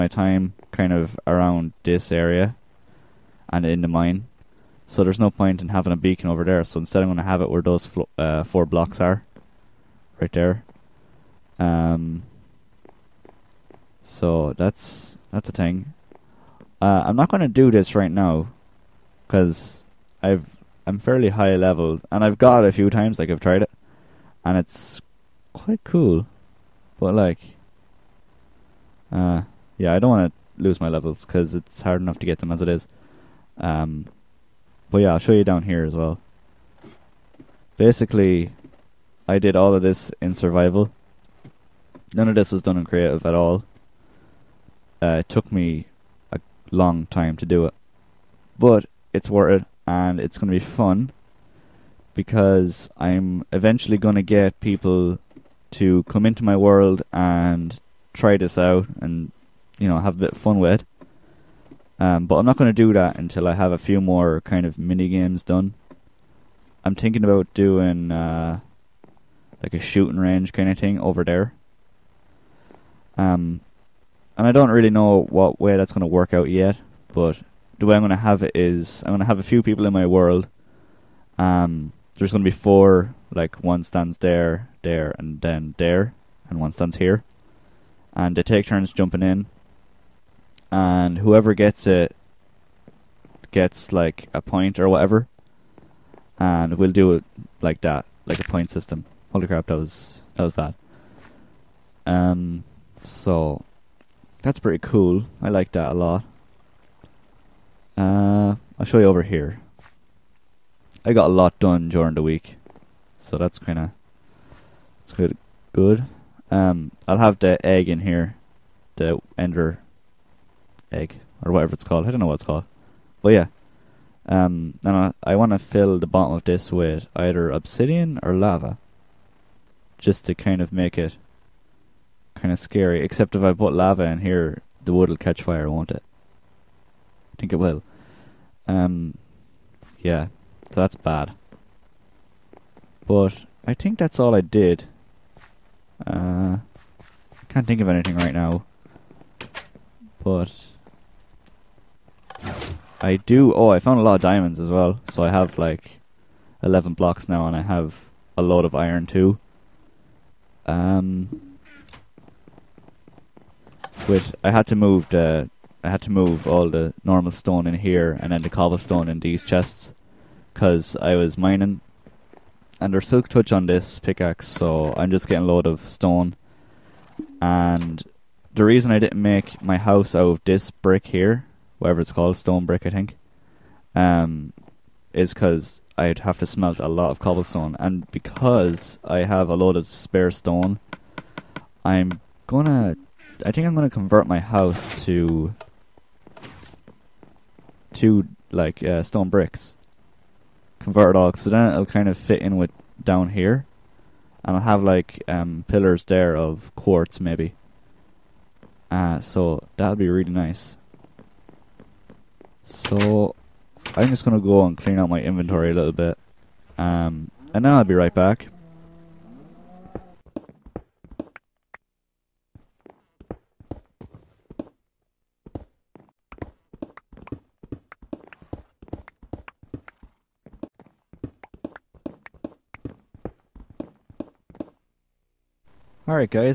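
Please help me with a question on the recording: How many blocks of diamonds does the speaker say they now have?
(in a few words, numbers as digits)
11.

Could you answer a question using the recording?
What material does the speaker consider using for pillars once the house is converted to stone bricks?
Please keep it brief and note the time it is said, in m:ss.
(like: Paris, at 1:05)
quartz, at 3:26.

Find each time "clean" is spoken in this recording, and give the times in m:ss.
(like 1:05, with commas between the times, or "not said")
3:34.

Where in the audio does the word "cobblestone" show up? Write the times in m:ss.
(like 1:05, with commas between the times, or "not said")
2:48, 3:07.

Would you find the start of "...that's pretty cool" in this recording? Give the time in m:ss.
1:44.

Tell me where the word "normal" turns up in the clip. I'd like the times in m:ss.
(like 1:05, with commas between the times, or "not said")
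2:47.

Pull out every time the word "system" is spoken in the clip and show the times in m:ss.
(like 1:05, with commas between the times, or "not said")
1:38.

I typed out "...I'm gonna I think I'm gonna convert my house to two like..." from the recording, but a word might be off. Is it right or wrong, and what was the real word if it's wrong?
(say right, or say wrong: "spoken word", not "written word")
right.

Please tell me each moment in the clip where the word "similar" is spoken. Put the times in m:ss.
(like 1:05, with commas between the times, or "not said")
not said.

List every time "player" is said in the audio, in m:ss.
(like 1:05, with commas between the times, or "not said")
not said.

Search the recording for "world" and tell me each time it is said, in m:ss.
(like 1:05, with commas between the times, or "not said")
0:56, 1:20.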